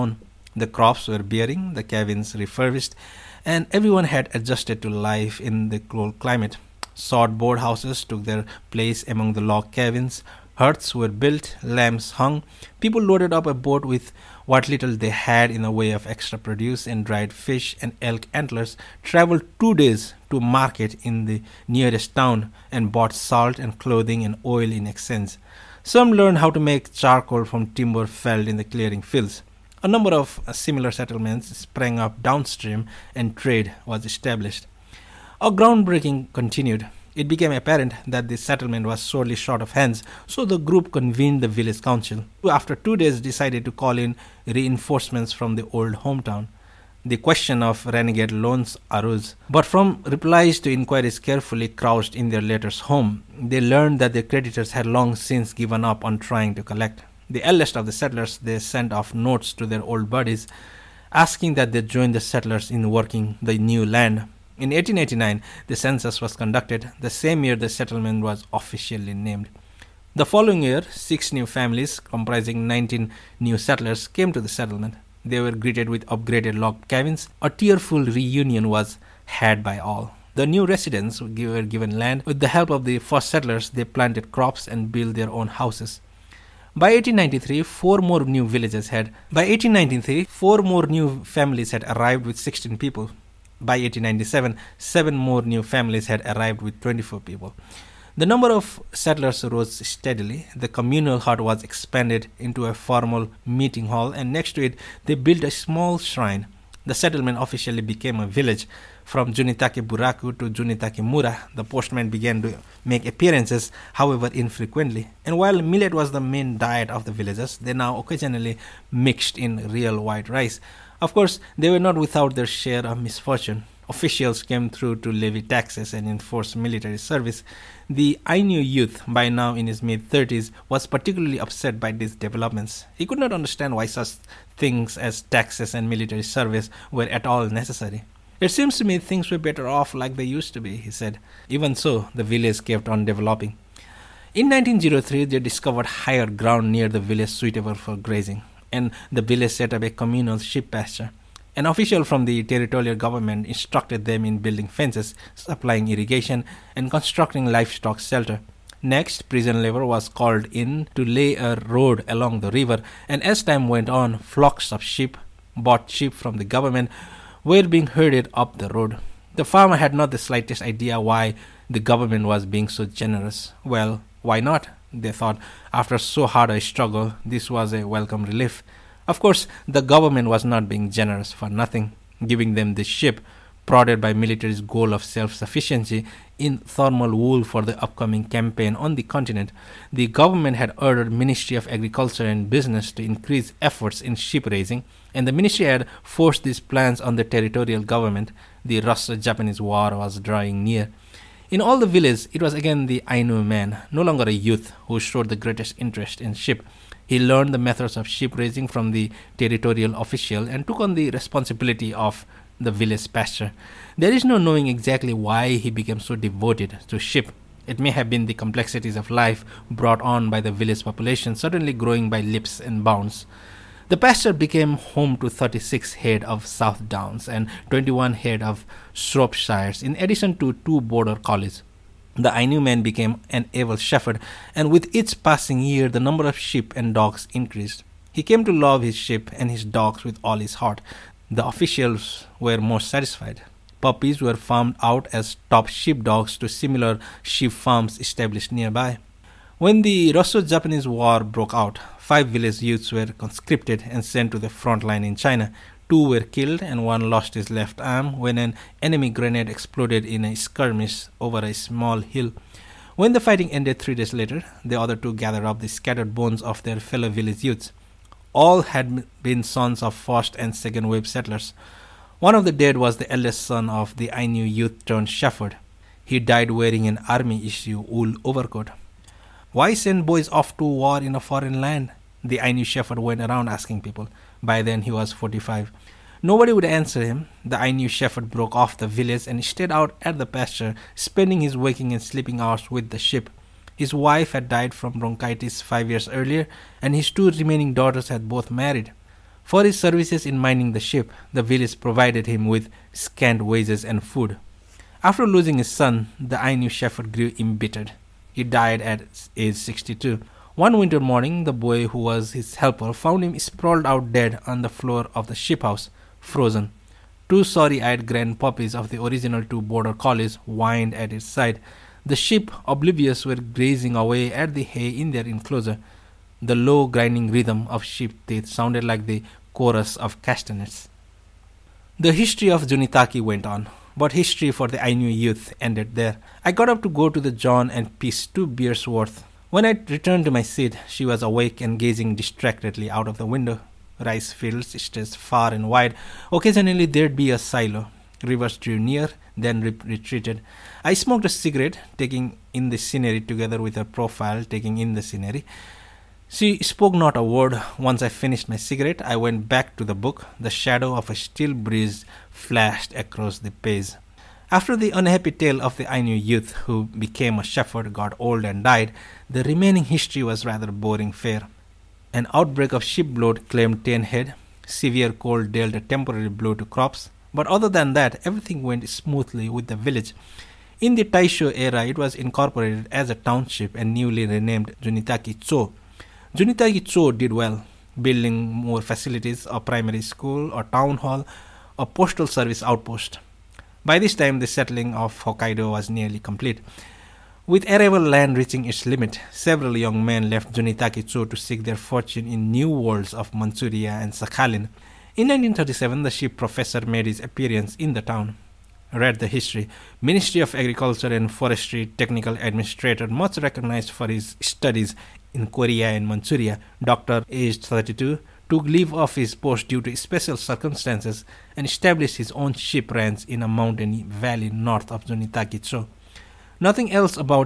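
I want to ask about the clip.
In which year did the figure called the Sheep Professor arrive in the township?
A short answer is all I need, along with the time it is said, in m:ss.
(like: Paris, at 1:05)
1937, at 6:45.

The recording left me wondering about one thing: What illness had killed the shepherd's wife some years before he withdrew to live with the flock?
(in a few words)
bronchitis.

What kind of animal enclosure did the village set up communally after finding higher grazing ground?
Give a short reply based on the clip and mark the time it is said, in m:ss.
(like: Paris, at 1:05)
sheep pasture, at 2:29.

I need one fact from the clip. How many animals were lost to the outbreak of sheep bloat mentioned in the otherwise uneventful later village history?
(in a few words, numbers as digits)
10.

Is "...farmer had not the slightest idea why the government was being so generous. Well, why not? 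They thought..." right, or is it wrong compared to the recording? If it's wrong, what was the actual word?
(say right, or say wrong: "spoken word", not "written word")
right.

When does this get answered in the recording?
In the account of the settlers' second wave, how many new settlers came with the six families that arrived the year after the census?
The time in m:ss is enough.
1:12.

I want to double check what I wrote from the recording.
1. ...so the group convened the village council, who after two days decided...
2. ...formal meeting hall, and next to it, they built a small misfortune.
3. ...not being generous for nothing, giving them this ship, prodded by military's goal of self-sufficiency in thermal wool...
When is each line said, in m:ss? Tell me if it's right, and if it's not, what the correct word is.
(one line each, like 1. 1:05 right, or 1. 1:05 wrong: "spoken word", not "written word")
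1. 0:40 right
2. 1:42 wrong: "shrine", not "misfortune"
3. 3:00 right.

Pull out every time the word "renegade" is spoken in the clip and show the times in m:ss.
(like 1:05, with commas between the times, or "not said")
0:47.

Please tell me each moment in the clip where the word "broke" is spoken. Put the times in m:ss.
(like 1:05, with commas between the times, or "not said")
4:11, 4:48.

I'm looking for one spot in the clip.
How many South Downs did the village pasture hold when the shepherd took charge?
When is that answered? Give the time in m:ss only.
3:45.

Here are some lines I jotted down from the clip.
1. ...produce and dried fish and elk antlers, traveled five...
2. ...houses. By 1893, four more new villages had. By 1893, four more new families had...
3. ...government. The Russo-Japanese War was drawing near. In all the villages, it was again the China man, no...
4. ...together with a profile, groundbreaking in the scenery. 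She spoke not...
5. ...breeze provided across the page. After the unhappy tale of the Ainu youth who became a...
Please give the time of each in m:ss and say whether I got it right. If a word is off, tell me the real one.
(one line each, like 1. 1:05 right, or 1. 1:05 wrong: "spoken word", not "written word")
1. 0:16 wrong: "two", not "five"
2. 1:25 right
3. 3:17 wrong: "Ainu", not "China"
4. 5:53 wrong: "taking", not "groundbreaking"
5. 6:01 wrong: "flashed", not "provided".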